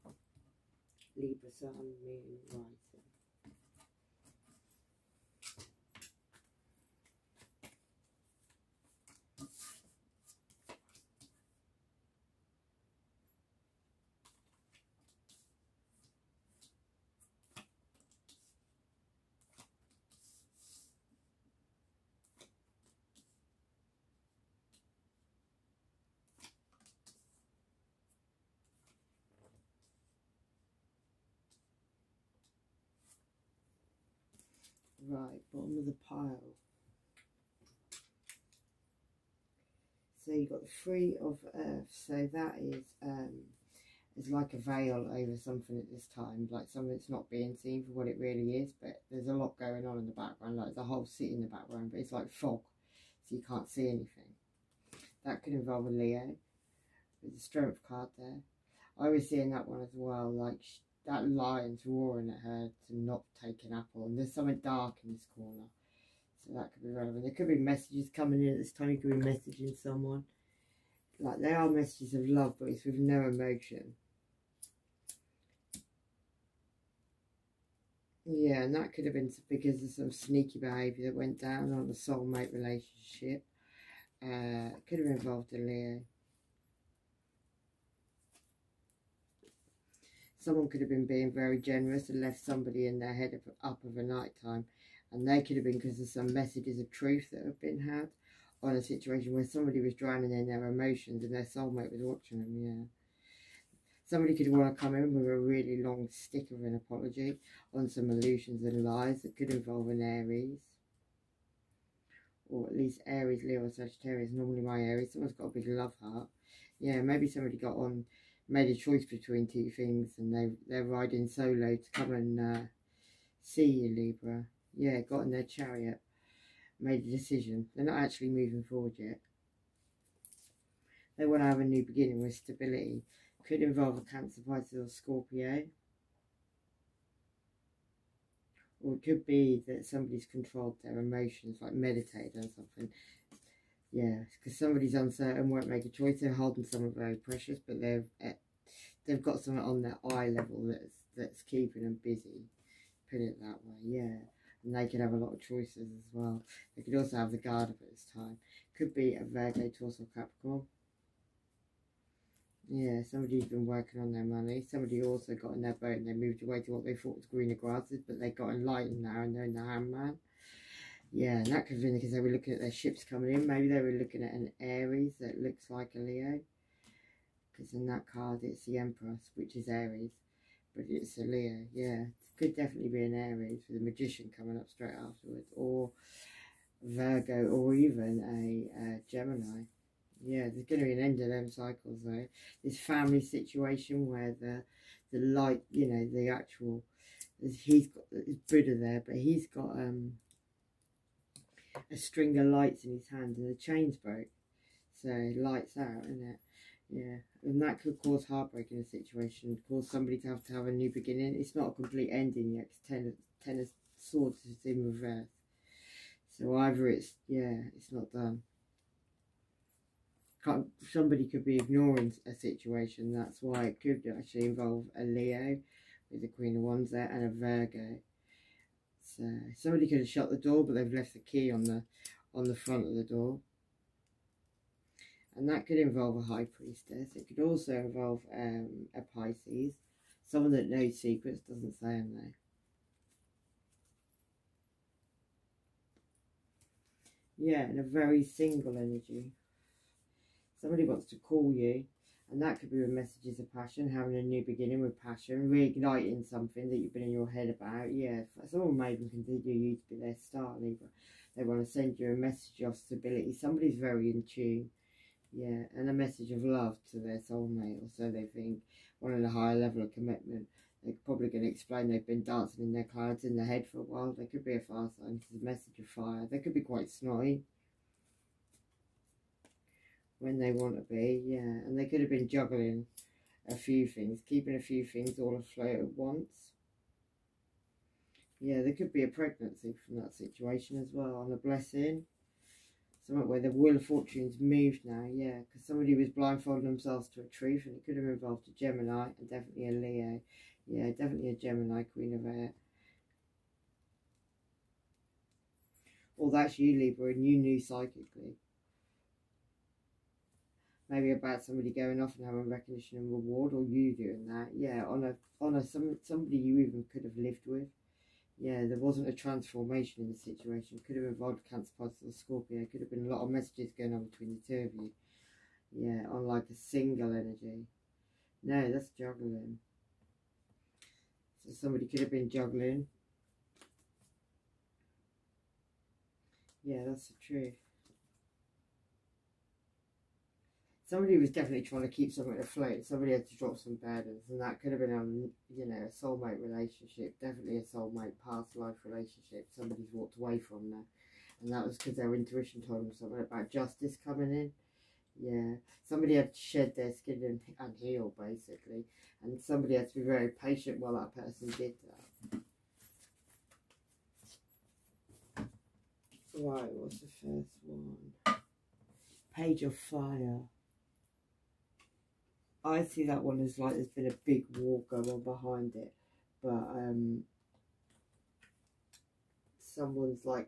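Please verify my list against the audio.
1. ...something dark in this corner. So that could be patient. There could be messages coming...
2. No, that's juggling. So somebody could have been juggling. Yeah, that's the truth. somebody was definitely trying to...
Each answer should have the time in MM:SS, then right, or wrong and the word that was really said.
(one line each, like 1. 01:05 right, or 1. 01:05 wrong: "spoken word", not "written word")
1. 01:04 wrong: "relevant", not "patient"
2. 05:28 right.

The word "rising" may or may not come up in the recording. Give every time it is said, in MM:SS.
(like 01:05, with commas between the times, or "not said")
00:02.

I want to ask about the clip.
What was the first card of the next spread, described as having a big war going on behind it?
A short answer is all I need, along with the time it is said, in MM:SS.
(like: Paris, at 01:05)
Page of Fire, at 06:09.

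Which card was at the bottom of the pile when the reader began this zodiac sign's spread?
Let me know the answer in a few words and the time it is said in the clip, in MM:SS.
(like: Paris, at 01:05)
Three of Earth, at 00:40.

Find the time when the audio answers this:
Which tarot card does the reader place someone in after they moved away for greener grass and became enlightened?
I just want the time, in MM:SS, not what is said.
02:49.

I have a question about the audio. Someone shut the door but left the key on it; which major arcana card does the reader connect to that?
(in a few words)
High Priestess.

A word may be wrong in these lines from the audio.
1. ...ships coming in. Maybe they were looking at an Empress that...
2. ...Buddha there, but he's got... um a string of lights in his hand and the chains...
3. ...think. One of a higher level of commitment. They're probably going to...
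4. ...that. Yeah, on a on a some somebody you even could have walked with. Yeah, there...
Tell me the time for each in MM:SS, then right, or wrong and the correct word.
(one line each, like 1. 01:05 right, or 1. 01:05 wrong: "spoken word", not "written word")
1. 02:52 wrong: "Aries", not "Empress"
2. 03:18 right
3. 04:28 right
4. 05:14 wrong: "lived", not "walked".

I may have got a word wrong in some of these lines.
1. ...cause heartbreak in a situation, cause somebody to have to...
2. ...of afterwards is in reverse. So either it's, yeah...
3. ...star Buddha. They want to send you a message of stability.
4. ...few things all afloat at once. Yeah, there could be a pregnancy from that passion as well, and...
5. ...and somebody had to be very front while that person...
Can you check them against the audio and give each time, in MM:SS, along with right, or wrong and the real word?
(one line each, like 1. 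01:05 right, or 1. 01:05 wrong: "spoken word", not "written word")
1. 03:28 right
2. 03:33 wrong: "swords", not "afterwards"
3. 04:20 wrong: "Libra", not "Buddha"
4. 04:44 wrong: "situation", not "passion"
5. 05:59 wrong: "patient", not "front".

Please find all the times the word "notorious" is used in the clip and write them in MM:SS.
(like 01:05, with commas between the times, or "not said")
not said.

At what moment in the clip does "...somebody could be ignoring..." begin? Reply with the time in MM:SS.
03:40.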